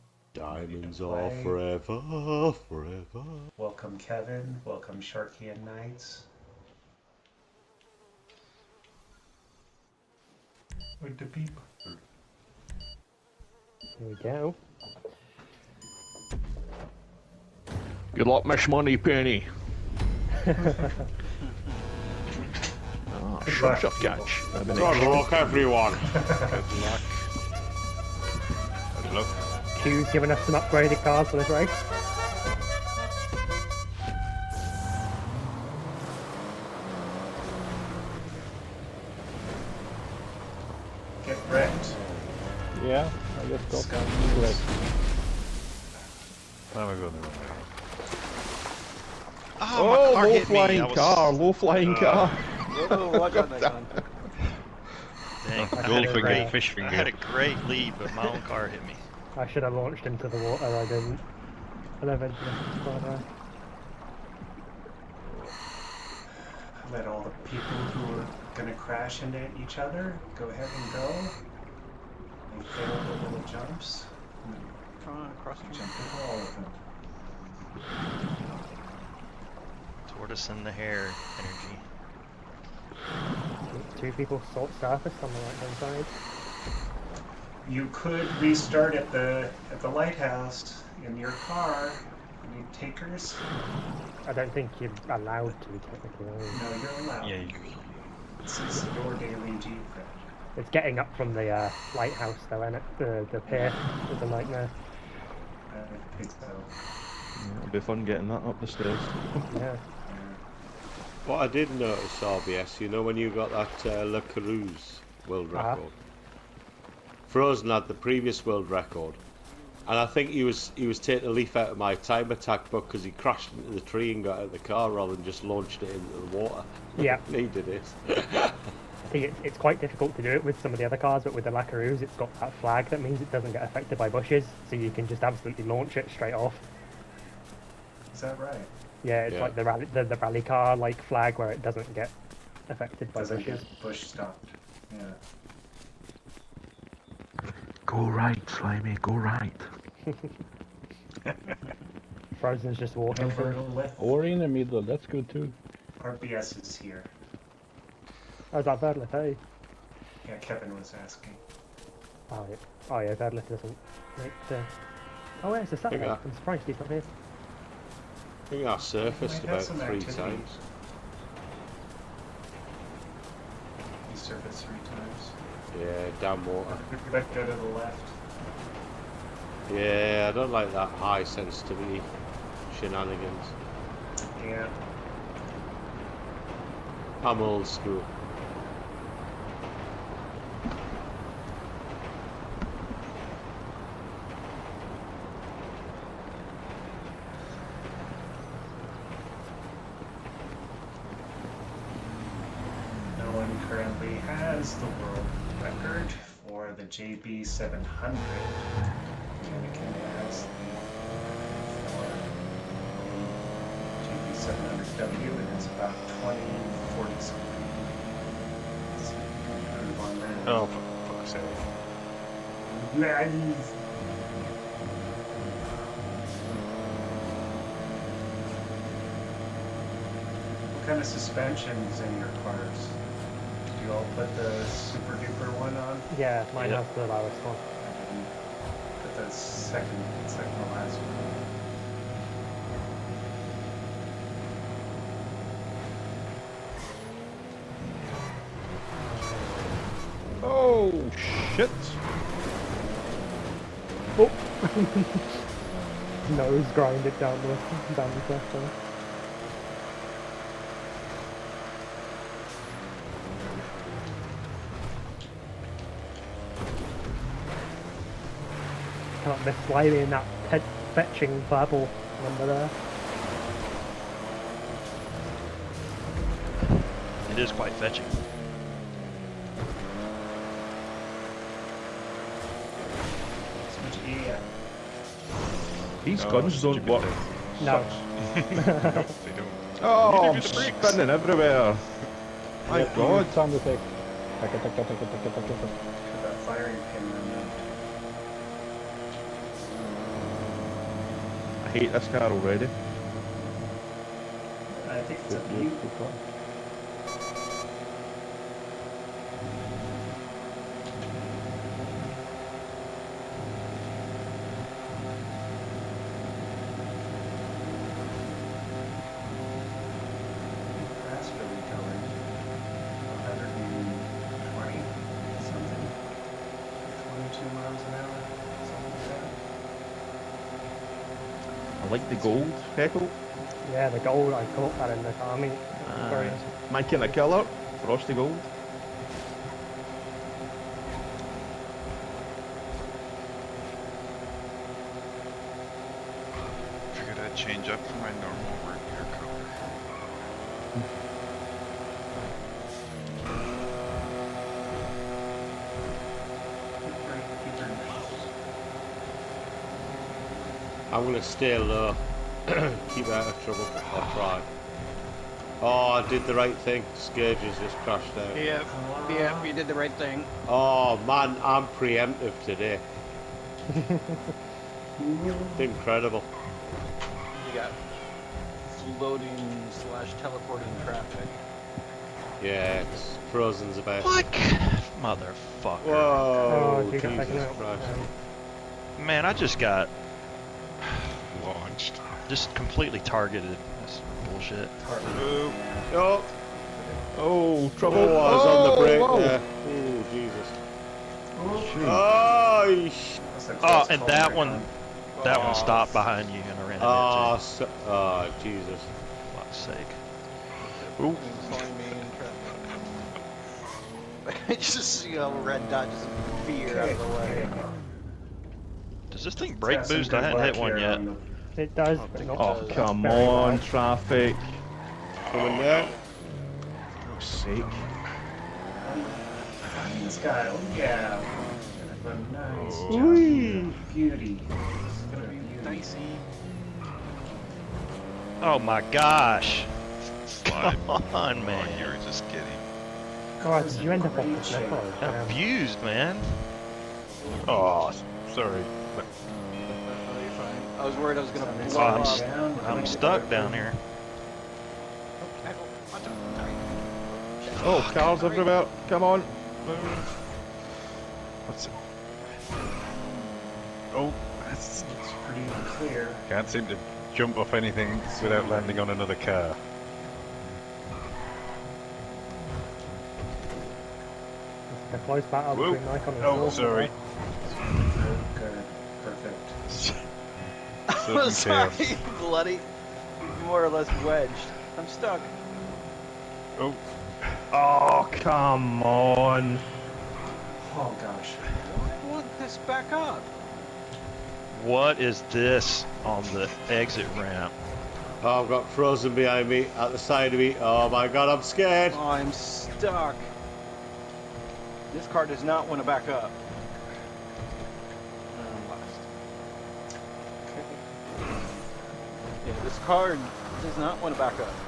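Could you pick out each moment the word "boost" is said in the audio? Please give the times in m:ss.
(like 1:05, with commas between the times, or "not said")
6:59.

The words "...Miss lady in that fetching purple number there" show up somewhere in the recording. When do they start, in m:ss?
4:29.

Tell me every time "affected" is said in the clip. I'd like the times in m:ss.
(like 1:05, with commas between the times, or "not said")
2:13, 2:22.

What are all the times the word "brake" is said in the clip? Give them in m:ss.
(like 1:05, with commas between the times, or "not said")
6:38, 6:59.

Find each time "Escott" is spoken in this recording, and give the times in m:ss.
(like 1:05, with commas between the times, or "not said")
5:01.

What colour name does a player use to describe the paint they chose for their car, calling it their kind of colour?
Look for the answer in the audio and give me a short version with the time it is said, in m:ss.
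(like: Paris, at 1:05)
Frosty gold, at 5:37.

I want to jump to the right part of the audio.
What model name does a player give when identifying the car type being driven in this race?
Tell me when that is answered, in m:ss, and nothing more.
3:34.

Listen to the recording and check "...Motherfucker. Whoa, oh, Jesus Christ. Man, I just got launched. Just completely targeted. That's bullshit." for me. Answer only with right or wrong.
right.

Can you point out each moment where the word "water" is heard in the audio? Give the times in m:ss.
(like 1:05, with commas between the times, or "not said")
1:00, 2:06, 2:56.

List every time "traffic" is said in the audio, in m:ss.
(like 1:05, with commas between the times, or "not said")
6:20, 7:03.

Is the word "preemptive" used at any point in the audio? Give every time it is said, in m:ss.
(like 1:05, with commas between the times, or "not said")
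6:11.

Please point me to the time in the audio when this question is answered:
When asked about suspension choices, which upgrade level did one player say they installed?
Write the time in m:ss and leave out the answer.
4:00.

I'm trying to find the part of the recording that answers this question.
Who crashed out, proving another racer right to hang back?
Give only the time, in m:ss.
6:06.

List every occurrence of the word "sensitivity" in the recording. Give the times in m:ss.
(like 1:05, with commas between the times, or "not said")
3:01.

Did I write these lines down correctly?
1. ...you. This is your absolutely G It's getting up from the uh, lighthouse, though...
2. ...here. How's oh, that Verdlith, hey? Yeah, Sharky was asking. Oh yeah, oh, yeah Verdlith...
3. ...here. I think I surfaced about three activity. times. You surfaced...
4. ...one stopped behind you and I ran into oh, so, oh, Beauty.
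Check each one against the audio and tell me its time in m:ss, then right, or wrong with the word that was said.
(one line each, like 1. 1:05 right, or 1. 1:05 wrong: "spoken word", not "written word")
1. 1:37 wrong: "daily", not "absolutely"
2. 2:36 wrong: "Kevin", not "Sharky"
3. 2:46 right
4. 6:45 wrong: "Jesus", not "Beauty".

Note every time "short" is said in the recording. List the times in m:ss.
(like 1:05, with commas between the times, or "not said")
not said.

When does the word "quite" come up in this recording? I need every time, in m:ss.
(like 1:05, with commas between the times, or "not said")
2:09, 4:37.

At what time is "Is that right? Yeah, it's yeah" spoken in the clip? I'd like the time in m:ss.
2:18.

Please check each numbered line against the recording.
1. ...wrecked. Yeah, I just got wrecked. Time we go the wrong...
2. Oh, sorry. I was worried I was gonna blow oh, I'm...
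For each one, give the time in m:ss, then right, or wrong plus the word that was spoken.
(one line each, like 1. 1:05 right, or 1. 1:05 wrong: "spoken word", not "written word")
1. 0:41 right
2. 7:27 right.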